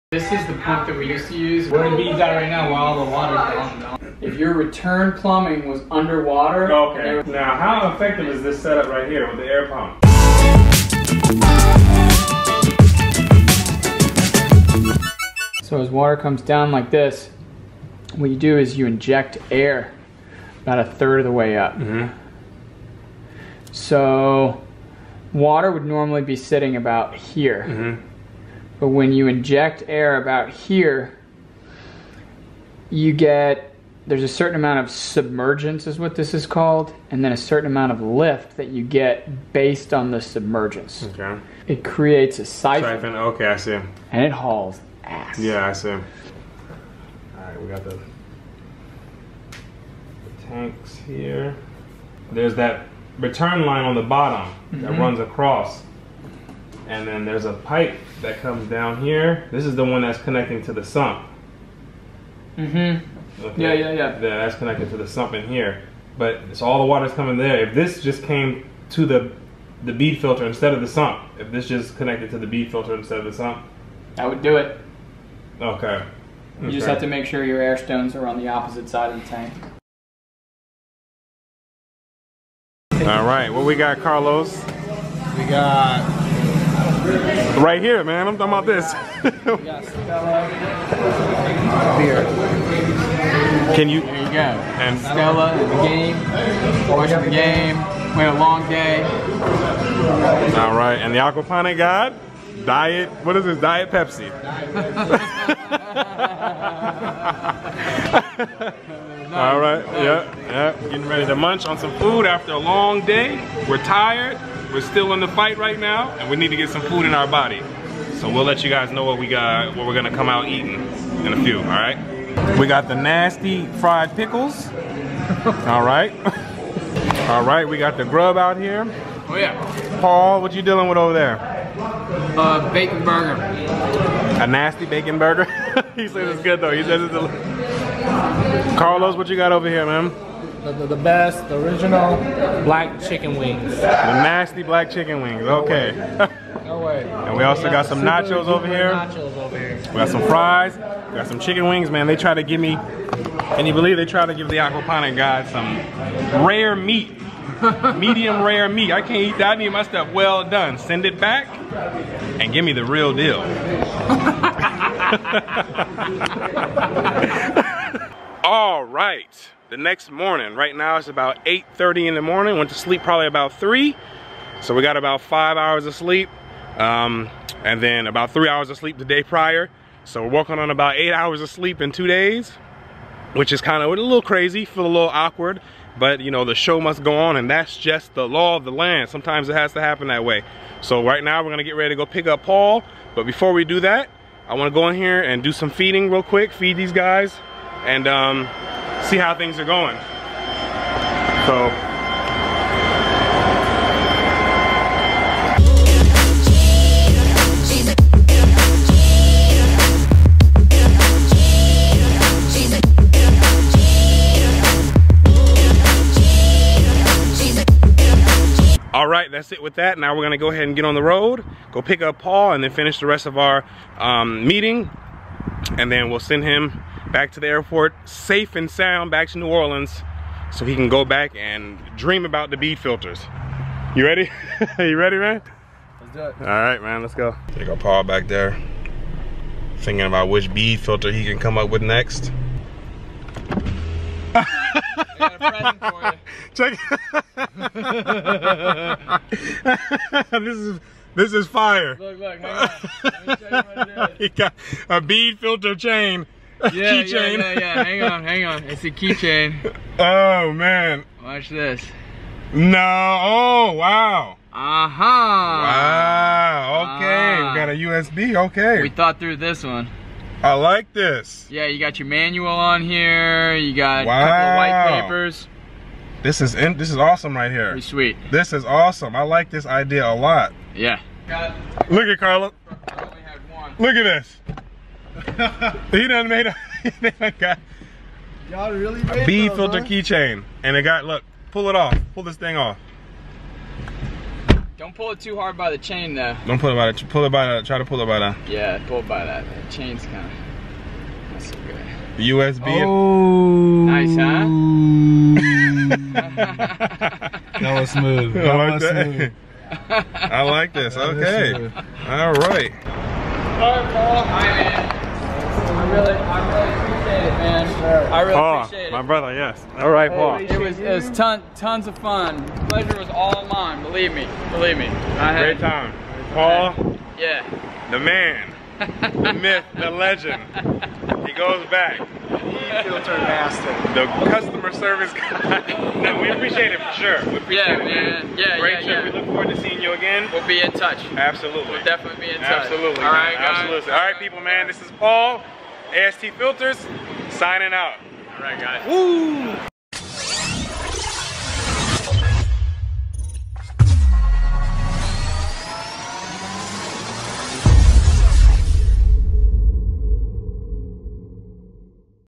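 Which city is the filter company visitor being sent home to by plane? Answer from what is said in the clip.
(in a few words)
New Orleans.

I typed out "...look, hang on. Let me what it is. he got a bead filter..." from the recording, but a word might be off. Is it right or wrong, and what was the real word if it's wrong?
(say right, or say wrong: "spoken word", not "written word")
right.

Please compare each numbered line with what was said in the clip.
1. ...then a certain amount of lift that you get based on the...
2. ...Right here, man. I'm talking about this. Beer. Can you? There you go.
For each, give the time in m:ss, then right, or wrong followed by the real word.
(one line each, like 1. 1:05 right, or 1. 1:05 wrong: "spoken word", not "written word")
1. 0:37 right
2. 1:27 right.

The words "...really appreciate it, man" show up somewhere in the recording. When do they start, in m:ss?
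5:16.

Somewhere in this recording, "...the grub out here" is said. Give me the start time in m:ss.
2:07.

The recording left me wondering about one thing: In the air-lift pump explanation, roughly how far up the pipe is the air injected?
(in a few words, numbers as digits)
a third of the way up.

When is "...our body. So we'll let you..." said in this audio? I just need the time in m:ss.
1:57.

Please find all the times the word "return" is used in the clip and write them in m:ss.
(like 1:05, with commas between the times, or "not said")
0:04, 0:53.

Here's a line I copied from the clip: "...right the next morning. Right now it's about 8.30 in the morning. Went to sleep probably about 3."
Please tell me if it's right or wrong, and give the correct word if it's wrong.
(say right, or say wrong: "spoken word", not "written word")
right.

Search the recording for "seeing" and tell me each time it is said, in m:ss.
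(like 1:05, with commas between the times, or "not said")
5:39.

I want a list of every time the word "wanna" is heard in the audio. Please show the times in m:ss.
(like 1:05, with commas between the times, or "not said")
3:14.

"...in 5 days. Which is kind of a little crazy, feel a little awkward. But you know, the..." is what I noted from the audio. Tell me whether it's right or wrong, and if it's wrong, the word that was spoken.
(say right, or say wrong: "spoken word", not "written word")
wrong: "2", not "5".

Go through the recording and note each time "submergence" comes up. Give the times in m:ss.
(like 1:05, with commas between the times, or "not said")
0:34, 0:40.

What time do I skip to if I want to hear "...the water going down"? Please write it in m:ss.
0:03.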